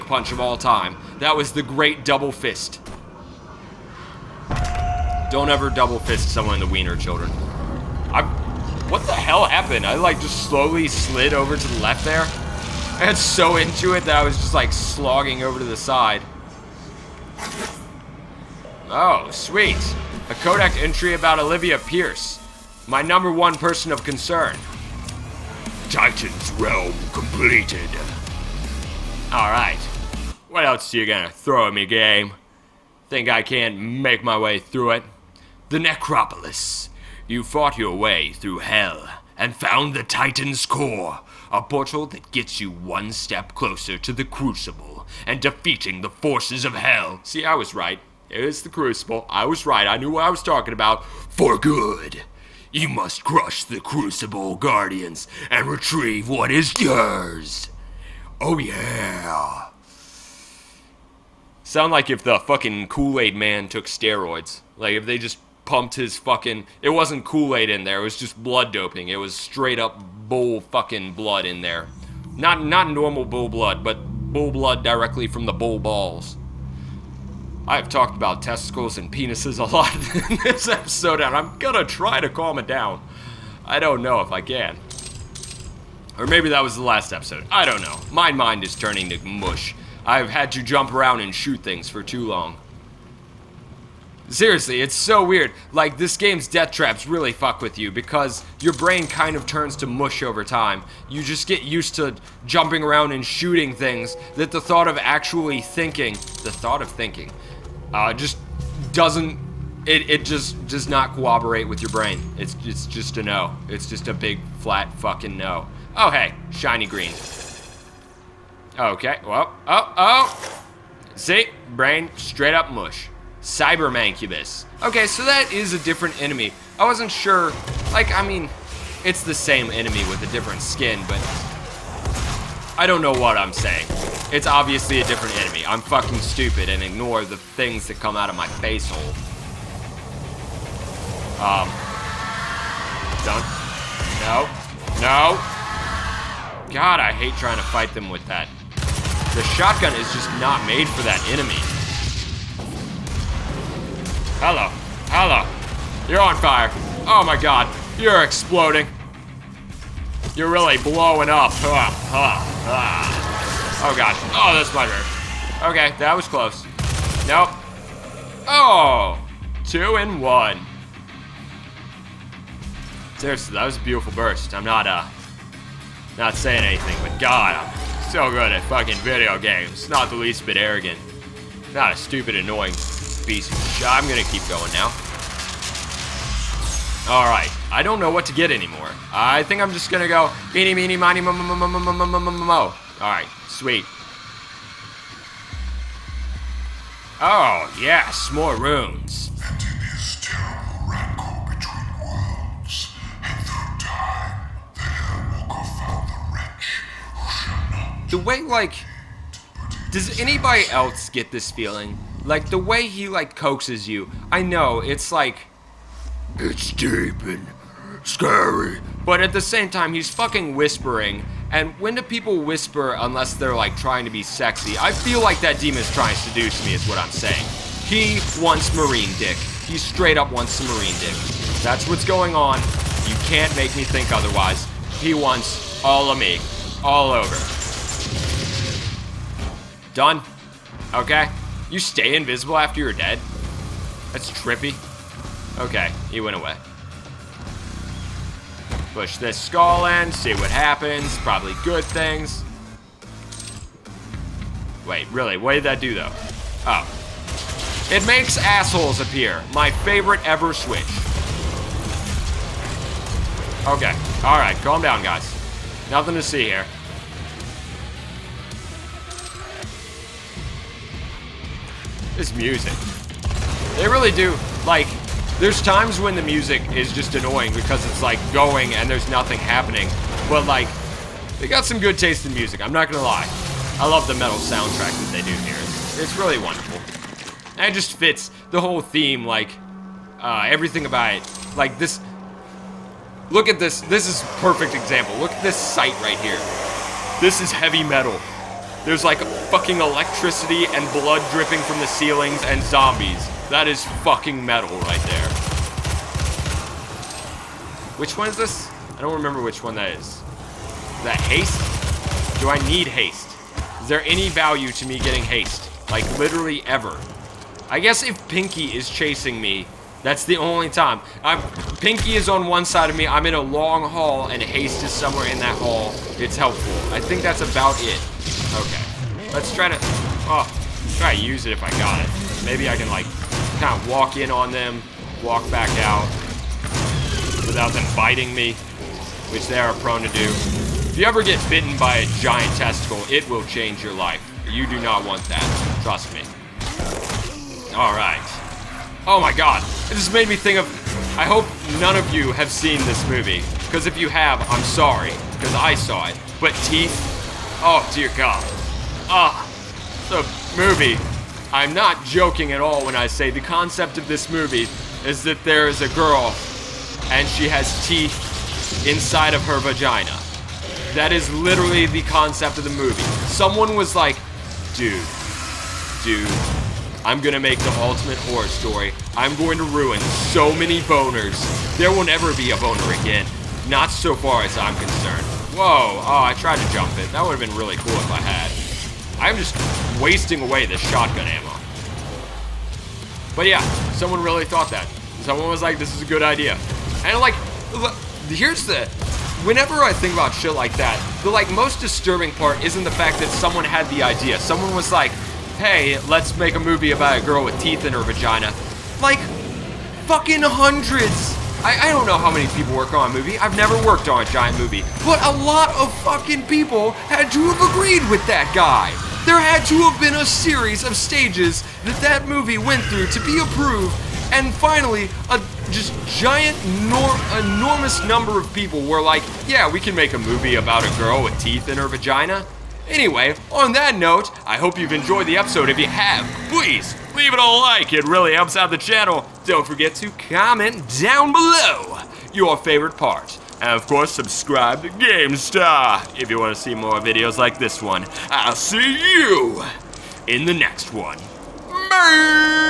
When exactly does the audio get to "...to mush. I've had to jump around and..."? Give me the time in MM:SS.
01:29.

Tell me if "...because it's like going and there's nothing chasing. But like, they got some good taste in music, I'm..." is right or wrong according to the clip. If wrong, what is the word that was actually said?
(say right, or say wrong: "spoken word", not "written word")
wrong: "happening", not "chasing".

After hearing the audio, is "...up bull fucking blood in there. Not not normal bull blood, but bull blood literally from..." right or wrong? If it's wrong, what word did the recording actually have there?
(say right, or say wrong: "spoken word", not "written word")
wrong: "directly", not "literally".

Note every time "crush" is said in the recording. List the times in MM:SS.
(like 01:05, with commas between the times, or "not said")
00:53.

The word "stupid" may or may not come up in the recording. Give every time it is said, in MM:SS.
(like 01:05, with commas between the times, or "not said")
02:16, 03:01.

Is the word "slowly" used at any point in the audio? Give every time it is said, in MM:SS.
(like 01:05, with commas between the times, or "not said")
00:10.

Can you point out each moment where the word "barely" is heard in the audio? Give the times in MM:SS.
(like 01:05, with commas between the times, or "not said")
not said.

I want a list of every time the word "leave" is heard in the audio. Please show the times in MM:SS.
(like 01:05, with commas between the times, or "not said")
07:17.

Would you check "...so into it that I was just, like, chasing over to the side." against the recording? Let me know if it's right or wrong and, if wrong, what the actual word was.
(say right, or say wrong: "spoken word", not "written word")
wrong: "slogging", not "chasing".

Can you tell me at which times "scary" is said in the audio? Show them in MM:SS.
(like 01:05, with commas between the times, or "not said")
03:38.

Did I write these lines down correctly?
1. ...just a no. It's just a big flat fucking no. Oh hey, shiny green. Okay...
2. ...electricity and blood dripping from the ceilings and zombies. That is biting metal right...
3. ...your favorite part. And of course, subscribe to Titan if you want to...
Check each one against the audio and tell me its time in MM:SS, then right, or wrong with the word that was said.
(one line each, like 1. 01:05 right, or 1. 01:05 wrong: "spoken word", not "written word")
1. 01:52 right
2. 04:59 wrong: "fucking", not "biting"
3. 07:22 wrong: "GameStarr", not "Titan".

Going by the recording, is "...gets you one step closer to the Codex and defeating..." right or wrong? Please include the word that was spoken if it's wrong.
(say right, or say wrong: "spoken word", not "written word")
wrong: "Crucible", not "Codex".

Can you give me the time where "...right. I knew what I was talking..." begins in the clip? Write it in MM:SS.
00:49.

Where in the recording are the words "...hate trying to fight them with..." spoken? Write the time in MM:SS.
02:27.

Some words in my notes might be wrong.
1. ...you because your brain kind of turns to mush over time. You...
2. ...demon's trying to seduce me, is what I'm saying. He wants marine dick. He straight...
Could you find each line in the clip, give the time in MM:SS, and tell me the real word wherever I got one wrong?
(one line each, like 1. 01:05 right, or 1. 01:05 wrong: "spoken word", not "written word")
1. 01:37 right
2. 03:45 right.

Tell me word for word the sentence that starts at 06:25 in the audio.
Whoa, oh, I tried to jump it.